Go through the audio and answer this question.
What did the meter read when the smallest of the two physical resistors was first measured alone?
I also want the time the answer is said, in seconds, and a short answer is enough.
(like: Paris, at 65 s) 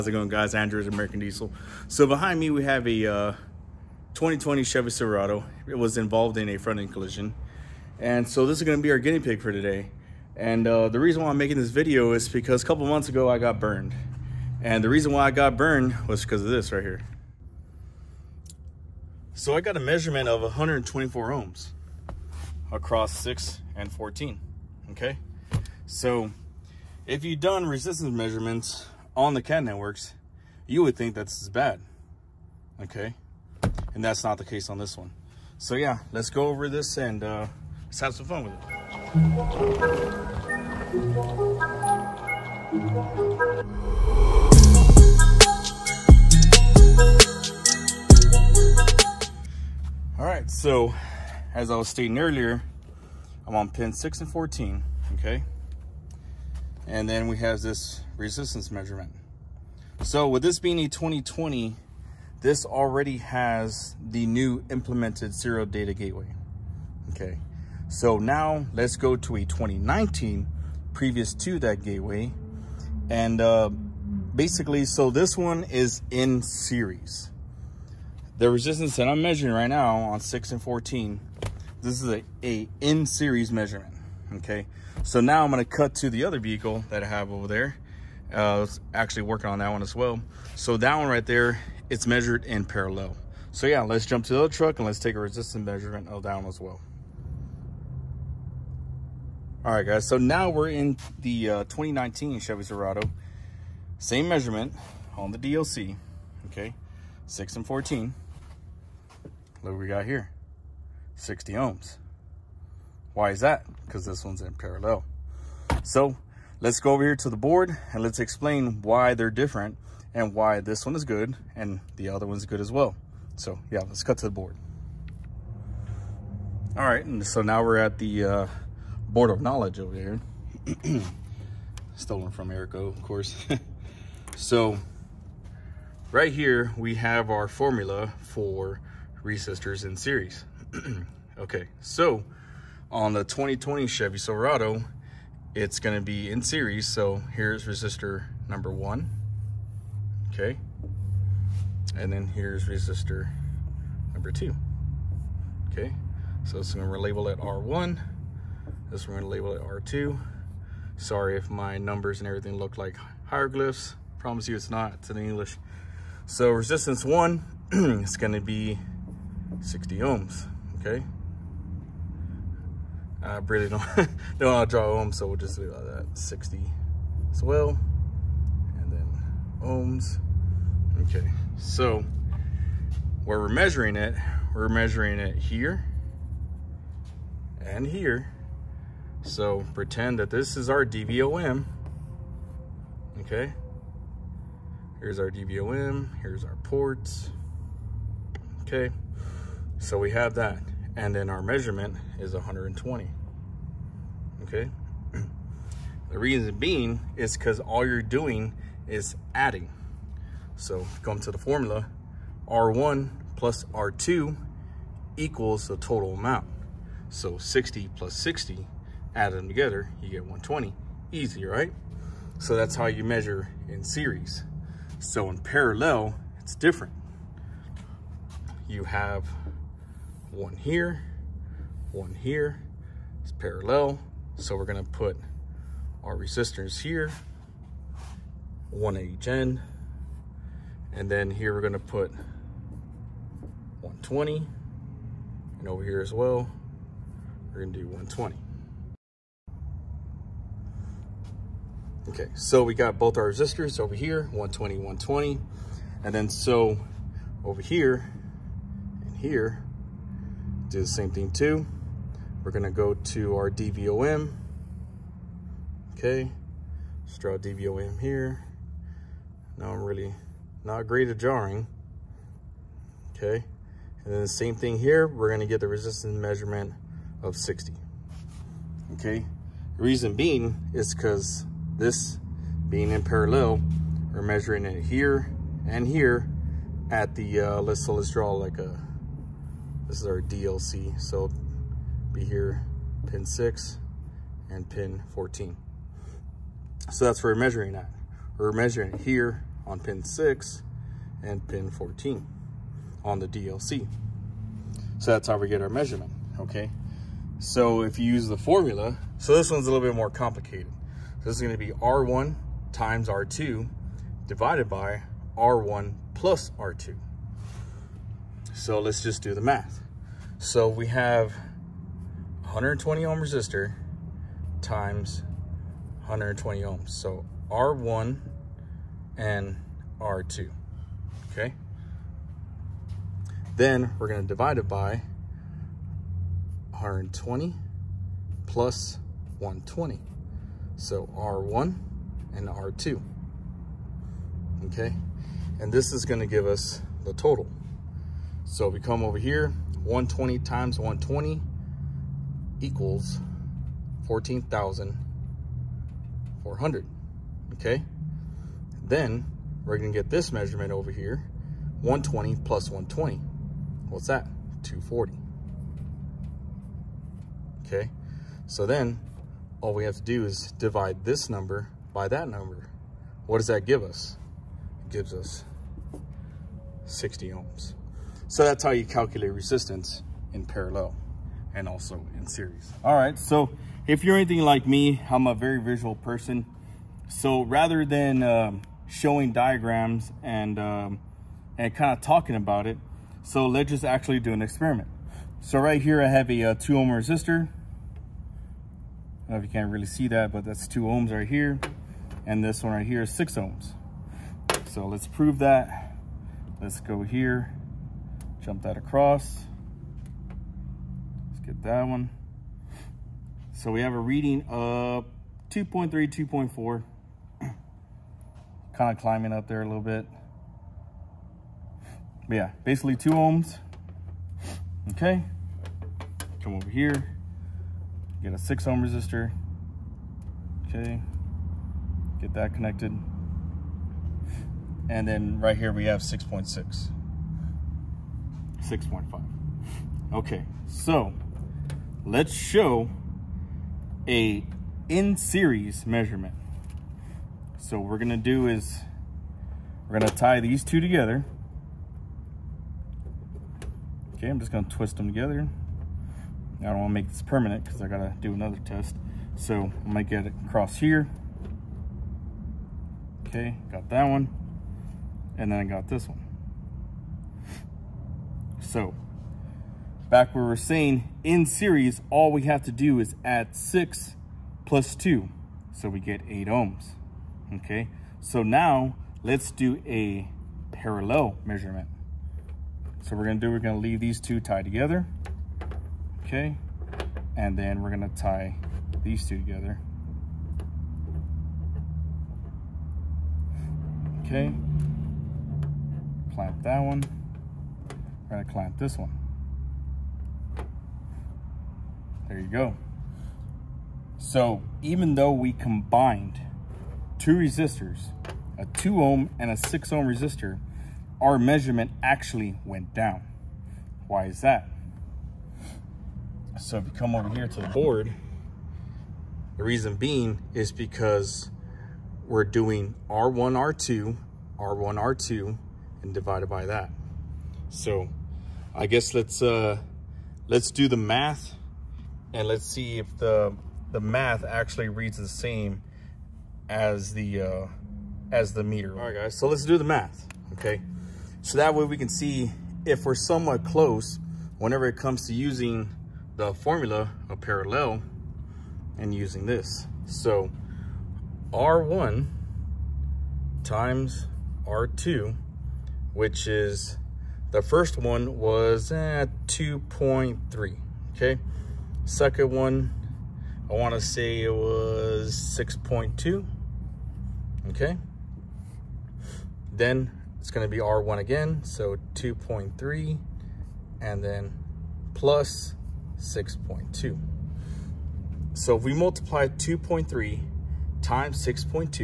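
2.3, at 415 s.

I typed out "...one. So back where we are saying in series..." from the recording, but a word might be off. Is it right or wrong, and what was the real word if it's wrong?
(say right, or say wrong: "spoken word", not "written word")
right.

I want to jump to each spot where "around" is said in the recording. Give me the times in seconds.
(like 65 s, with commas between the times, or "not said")
not said.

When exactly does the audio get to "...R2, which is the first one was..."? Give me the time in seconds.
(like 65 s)
554 s.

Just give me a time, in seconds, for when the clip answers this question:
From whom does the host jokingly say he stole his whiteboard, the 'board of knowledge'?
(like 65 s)
132 s.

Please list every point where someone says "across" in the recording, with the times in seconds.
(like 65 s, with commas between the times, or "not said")
22 s, 408 s, 460 s.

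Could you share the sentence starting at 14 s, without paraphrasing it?
And the reason why I got burned was because of this right here.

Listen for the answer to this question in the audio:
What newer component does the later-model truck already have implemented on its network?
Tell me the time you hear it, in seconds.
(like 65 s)
65 s.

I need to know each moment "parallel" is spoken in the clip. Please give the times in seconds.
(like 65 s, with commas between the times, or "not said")
92 s, 114 s, 225 s, 233 s, 283 s, 380 s, 480 s, 547 s.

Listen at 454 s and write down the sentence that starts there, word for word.
Okay, I'm just gonna twist them together.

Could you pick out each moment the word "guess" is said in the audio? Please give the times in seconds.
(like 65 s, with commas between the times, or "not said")
528 s.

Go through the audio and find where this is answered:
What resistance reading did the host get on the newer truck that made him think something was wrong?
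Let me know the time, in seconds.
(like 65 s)
20 s.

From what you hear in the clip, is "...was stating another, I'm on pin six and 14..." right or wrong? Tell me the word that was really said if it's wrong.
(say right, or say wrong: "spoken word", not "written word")
wrong: "earlier", not "another".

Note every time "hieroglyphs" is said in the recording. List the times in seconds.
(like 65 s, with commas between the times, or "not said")
163 s.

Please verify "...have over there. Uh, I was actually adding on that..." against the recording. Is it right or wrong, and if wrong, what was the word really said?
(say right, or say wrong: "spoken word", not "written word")
wrong: "working", not "adding".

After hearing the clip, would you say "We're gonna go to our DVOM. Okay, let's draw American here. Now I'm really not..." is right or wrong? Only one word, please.
wrong.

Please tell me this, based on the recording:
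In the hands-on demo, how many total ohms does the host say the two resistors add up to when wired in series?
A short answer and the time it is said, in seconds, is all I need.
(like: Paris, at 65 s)
8 ohms, at 476 s.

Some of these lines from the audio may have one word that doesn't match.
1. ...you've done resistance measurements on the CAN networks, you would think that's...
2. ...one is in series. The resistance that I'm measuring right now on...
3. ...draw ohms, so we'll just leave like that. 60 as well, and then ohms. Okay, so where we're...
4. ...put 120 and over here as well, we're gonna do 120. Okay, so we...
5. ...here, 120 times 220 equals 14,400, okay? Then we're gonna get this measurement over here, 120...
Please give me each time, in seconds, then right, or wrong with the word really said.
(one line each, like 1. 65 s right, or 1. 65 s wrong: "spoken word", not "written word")
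1. 27 s right
2. 75 s right
3. 174 s right
4. 241 s right
5. 349 s wrong: "120", not "220".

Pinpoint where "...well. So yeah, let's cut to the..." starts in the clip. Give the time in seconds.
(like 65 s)
122 s.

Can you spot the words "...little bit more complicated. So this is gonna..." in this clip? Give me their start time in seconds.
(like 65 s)
309 s.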